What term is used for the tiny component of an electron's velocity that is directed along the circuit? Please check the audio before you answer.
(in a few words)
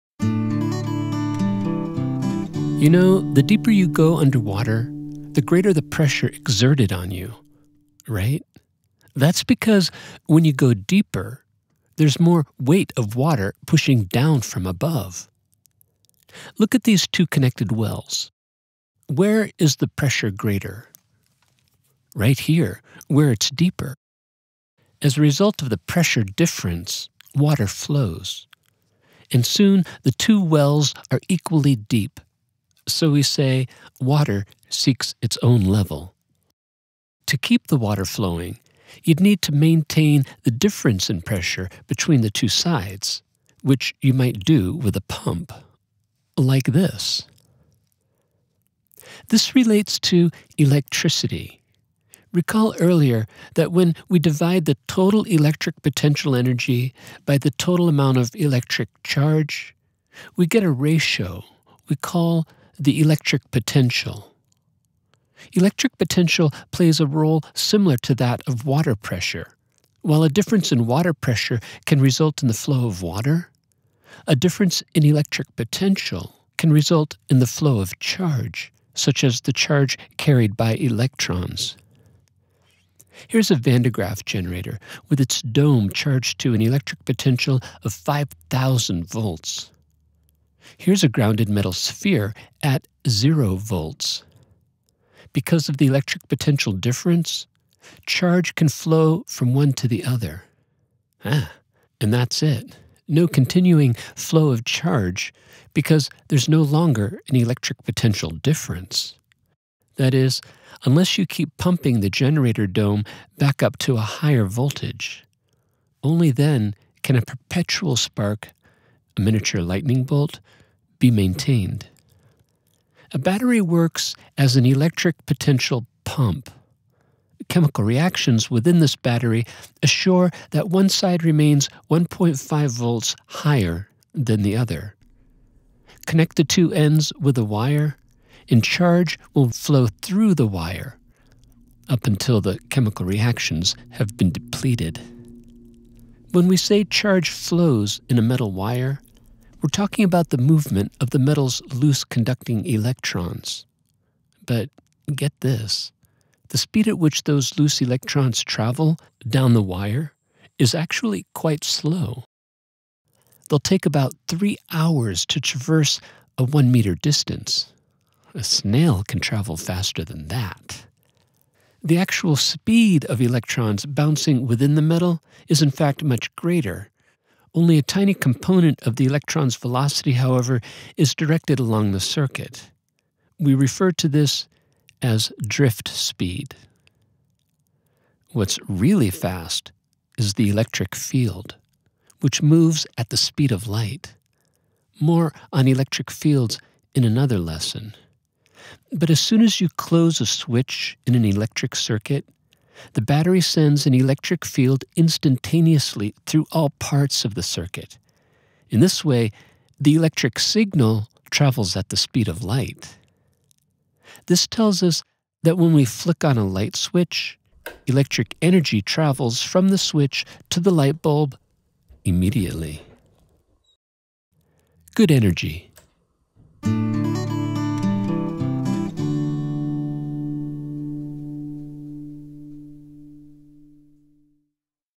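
drift speed.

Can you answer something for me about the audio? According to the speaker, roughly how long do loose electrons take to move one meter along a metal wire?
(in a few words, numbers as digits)
3 hours.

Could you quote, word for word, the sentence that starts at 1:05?
Electric potential plays a role similar to that of water pressure.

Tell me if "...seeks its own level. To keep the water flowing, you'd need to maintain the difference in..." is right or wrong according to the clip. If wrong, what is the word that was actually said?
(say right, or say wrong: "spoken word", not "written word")
right.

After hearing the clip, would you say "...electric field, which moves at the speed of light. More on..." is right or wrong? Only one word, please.
right.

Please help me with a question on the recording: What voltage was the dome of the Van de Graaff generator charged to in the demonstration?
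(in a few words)
5,000 volts.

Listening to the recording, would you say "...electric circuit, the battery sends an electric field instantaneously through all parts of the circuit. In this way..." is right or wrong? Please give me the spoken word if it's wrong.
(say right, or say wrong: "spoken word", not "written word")
right.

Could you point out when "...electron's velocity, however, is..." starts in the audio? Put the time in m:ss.
2:59.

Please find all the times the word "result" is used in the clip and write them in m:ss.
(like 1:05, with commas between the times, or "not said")
0:25, 1:12, 1:16.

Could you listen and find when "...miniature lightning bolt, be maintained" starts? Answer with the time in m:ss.
1:59.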